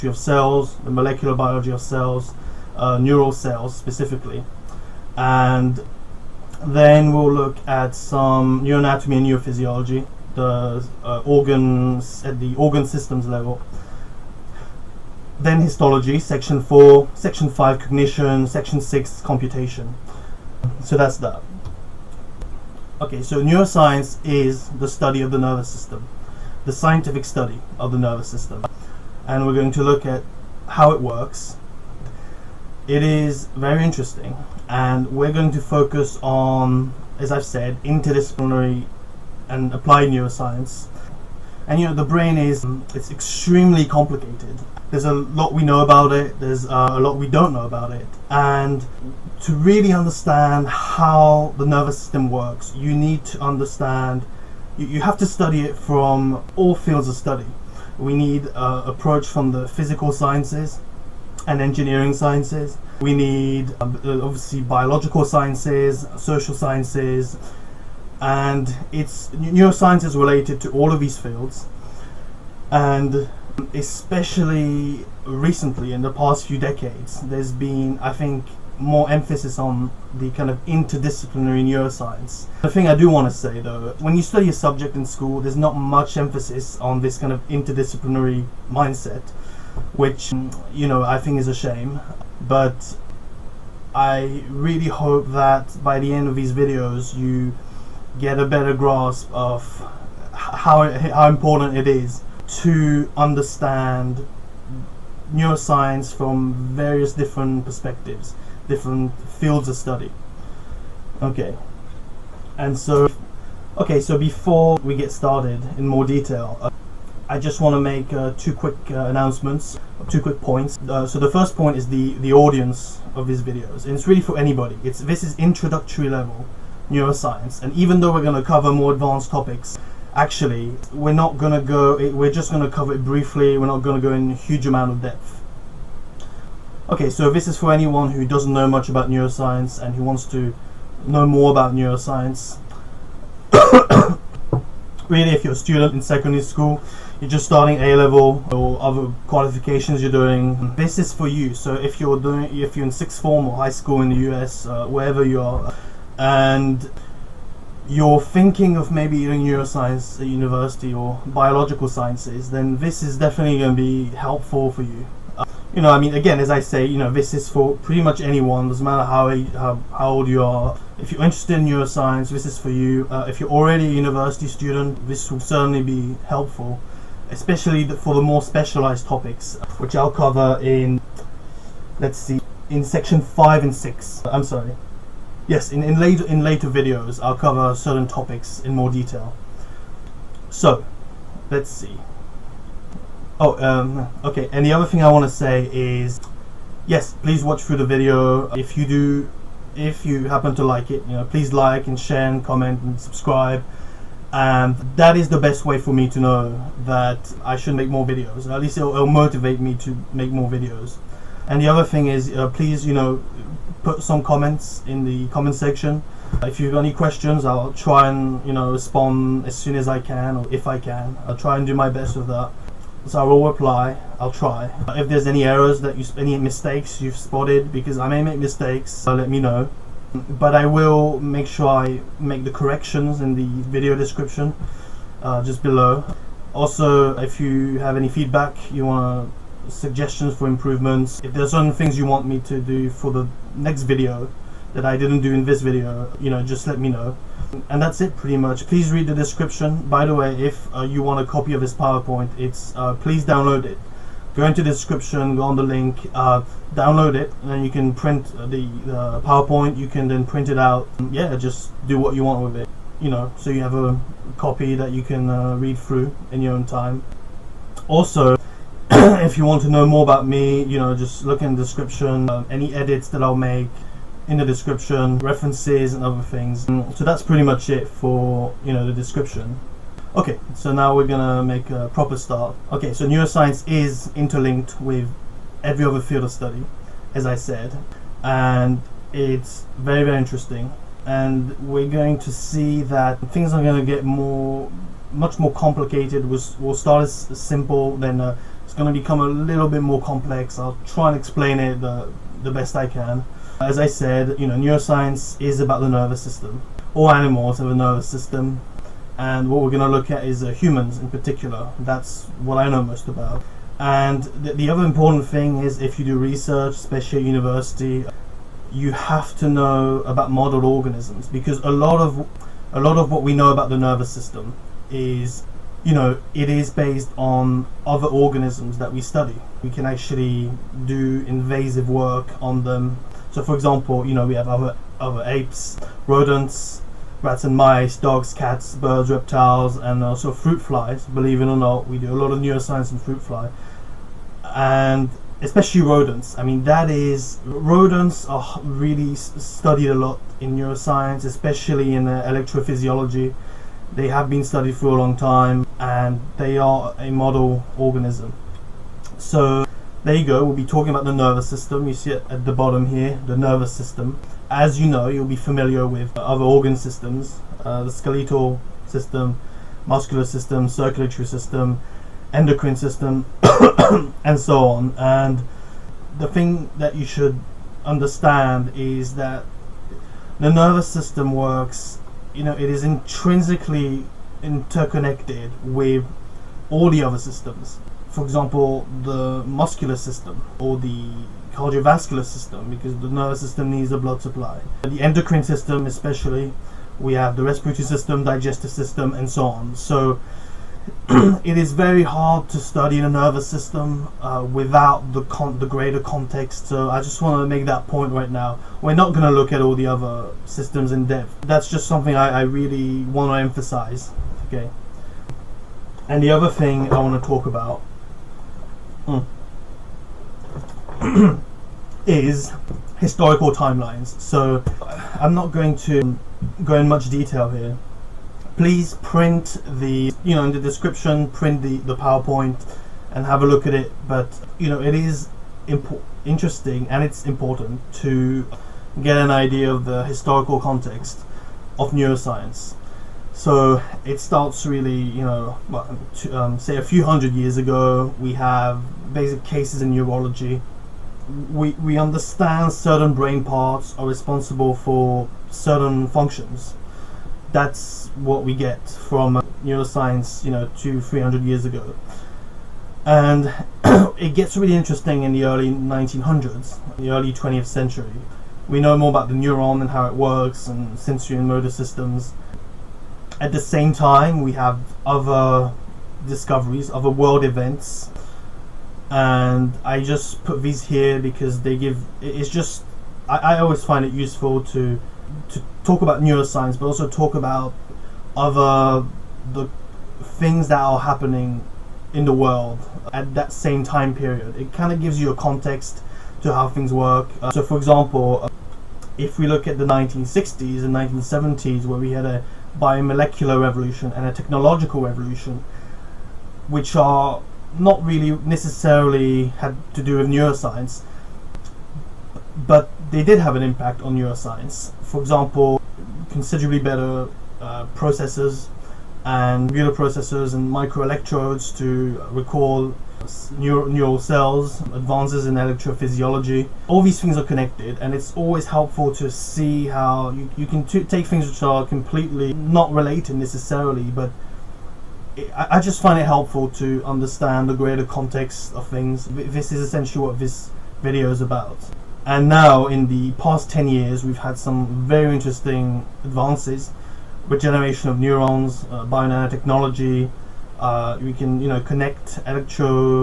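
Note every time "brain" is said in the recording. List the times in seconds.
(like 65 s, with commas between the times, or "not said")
42 s, 453 s.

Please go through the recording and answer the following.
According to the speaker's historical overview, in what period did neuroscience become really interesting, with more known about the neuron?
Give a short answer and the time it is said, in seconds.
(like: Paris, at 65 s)
Early 1900s, at 465 s.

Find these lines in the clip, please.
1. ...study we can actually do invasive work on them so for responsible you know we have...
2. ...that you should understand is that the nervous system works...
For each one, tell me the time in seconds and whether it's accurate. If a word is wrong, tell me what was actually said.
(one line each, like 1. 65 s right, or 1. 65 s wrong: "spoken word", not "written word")
1. 328 s wrong: "example", not "responsible"
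2. 376 s right.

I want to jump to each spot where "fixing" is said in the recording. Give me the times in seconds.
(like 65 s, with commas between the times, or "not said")
not said.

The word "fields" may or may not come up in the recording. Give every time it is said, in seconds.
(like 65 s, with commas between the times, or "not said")
56 s, 71 s, 109 s, 286 s.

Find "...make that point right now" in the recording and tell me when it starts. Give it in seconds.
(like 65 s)
407 s.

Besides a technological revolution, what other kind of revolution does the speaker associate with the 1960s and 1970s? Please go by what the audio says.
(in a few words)
Molecular revolution.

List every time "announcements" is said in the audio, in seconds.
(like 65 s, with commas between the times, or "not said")
119 s.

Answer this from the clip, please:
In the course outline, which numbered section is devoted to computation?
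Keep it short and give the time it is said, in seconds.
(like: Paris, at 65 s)
Section 6, at 18 s.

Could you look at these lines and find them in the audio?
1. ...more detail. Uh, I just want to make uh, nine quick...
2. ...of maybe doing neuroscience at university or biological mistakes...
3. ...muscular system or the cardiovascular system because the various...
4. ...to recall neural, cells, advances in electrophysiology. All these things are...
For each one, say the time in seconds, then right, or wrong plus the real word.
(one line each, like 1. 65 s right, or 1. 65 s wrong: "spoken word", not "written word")
1. 115 s wrong: "two", not "nine"
2. 158 s wrong: "sciences", not "mistakes"
3. 389 s wrong: "nervous", not "various"
4. 521 s right.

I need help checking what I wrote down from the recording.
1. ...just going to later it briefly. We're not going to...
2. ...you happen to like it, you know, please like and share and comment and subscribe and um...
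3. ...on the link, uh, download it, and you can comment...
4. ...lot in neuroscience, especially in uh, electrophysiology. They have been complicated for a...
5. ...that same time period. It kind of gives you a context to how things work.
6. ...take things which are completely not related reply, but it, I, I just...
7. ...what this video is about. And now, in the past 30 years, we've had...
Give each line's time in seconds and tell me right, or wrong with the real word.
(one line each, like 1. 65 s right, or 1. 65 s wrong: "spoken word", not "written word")
1. 132 s wrong: "cover", not "later"
2. 200 s right
3. 255 s wrong: "print", not "comment"
4. 349 s wrong: "studied", not "complicated"
5. 493 s right
6. 530 s wrong: "necessarily", not "reply"
7. 540 s wrong: "10", not "30".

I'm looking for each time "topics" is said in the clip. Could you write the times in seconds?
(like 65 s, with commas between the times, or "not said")
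129 s, 179 s, 188 s.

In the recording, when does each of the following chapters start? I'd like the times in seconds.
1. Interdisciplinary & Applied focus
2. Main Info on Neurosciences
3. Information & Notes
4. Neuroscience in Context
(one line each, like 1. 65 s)
1. 35 s
2. 282 s
3. 117 s
4. 293 s.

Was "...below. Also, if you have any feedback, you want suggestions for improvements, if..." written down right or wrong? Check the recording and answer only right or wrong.
right.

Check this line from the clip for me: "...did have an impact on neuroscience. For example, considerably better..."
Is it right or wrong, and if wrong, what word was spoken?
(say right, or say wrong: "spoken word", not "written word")
right.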